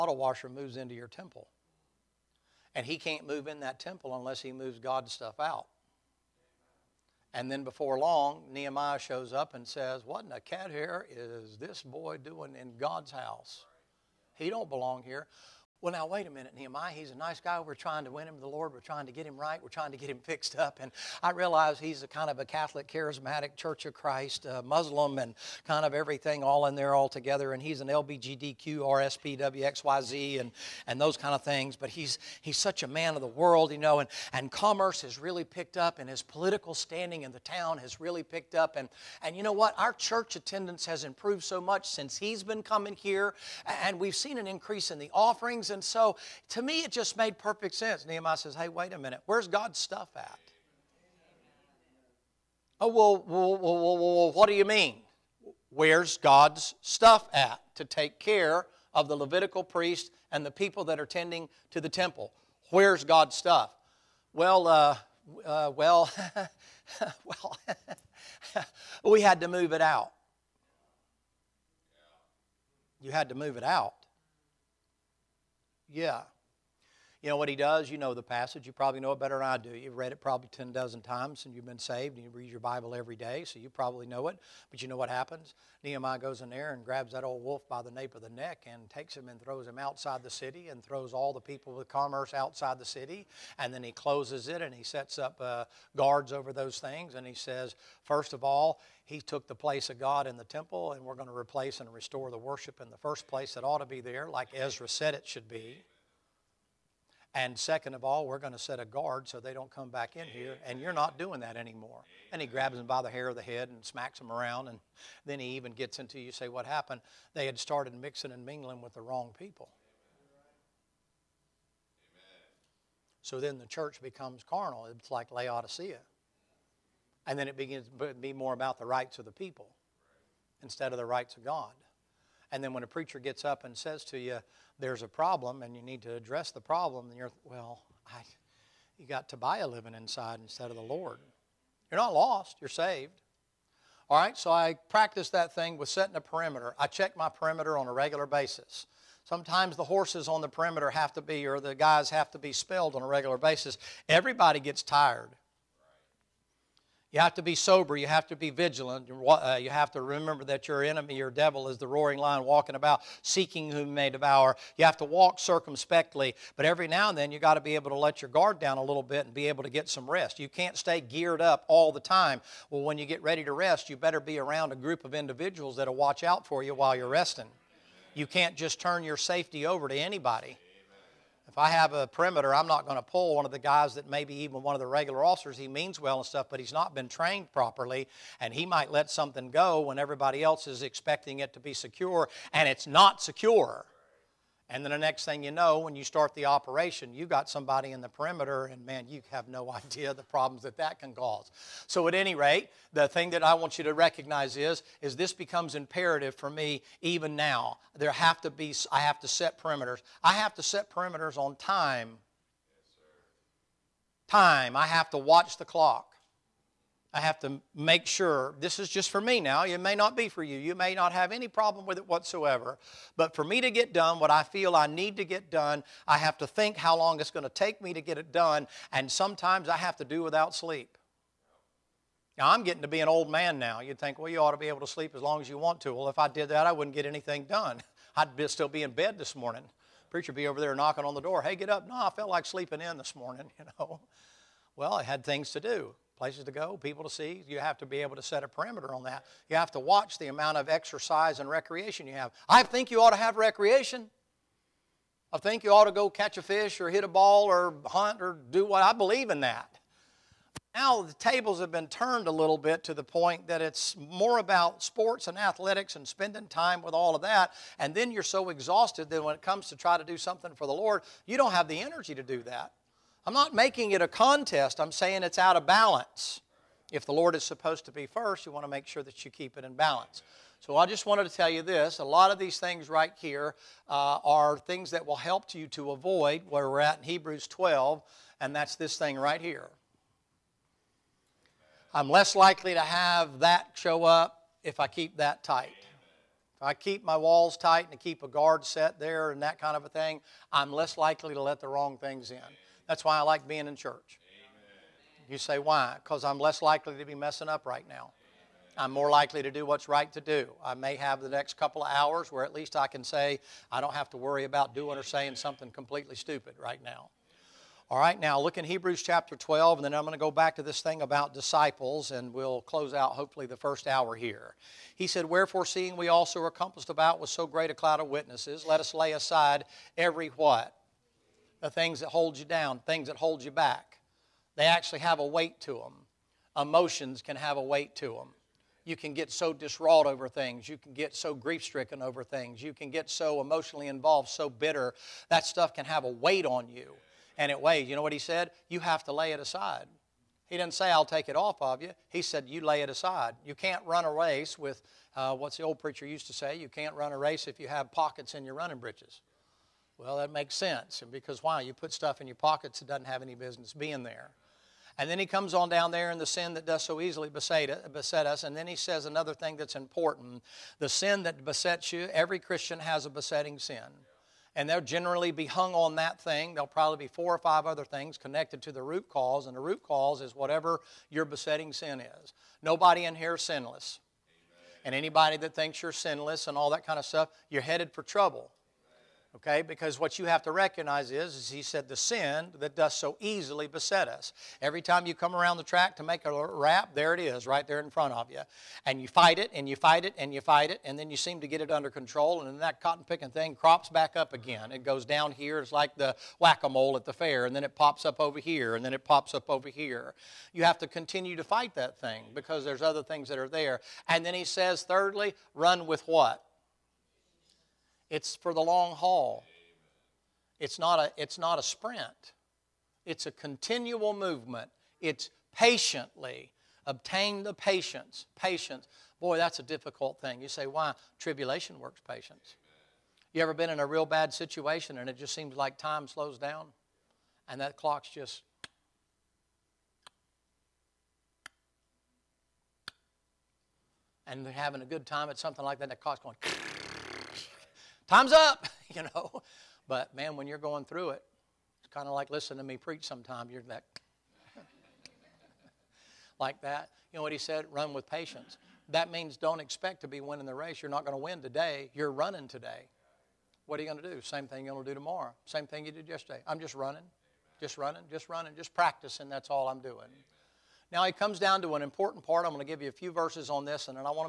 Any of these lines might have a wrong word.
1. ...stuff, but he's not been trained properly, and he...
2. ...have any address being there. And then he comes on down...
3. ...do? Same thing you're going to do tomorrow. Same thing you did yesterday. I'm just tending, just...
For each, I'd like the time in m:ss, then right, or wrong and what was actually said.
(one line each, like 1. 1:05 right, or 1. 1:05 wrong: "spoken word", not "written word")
1. 3:06 right
2. 6:03 wrong: "business", not "address"
3. 7:44 wrong: "running", not "tending".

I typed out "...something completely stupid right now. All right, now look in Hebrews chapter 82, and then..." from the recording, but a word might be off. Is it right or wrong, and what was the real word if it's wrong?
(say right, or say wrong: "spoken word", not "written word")
wrong: "12", not "82".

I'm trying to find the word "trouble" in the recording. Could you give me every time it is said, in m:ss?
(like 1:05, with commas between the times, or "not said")
6:28.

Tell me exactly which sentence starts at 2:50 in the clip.
You can't stay geared up all the time.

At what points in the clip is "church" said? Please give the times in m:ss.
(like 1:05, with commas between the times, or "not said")
0:23, 0:39, 2:03, 5:03.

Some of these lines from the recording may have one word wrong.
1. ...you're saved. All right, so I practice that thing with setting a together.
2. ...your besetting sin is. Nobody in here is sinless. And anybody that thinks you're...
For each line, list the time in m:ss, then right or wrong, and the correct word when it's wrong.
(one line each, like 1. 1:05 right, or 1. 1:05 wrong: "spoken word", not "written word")
1. 2:22 wrong: "perimeter", not "together"
2. 6:21 right.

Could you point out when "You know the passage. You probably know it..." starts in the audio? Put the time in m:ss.
1:17.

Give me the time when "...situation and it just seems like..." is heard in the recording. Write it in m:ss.
7:14.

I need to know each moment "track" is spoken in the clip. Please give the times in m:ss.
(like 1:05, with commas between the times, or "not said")
6:35.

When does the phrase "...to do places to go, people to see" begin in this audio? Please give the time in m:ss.
4:05.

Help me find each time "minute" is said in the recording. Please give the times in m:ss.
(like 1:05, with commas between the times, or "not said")
0:16, 0:48.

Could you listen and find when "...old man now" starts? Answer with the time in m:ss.
3:53.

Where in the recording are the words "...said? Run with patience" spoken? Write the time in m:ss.
7:37.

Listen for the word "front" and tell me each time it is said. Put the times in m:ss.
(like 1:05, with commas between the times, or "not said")
6:37.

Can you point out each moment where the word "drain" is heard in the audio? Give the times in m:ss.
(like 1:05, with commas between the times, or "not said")
not said.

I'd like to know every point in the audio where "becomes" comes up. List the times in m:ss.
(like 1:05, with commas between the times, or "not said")
2:04, 3:25.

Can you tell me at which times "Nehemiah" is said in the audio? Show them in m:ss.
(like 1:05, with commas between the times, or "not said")
0:08, 0:16, 0:48, 1:25.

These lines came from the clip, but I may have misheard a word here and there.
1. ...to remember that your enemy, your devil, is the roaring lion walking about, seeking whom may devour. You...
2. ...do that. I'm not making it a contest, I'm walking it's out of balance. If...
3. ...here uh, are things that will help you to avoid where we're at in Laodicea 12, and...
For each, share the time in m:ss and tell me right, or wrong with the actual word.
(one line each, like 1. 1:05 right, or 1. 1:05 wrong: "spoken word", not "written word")
1. 2:39 right
2. 4:32 wrong: "saying", not "walking"
3. 4:43 wrong: "Hebrews", not "Laodicea".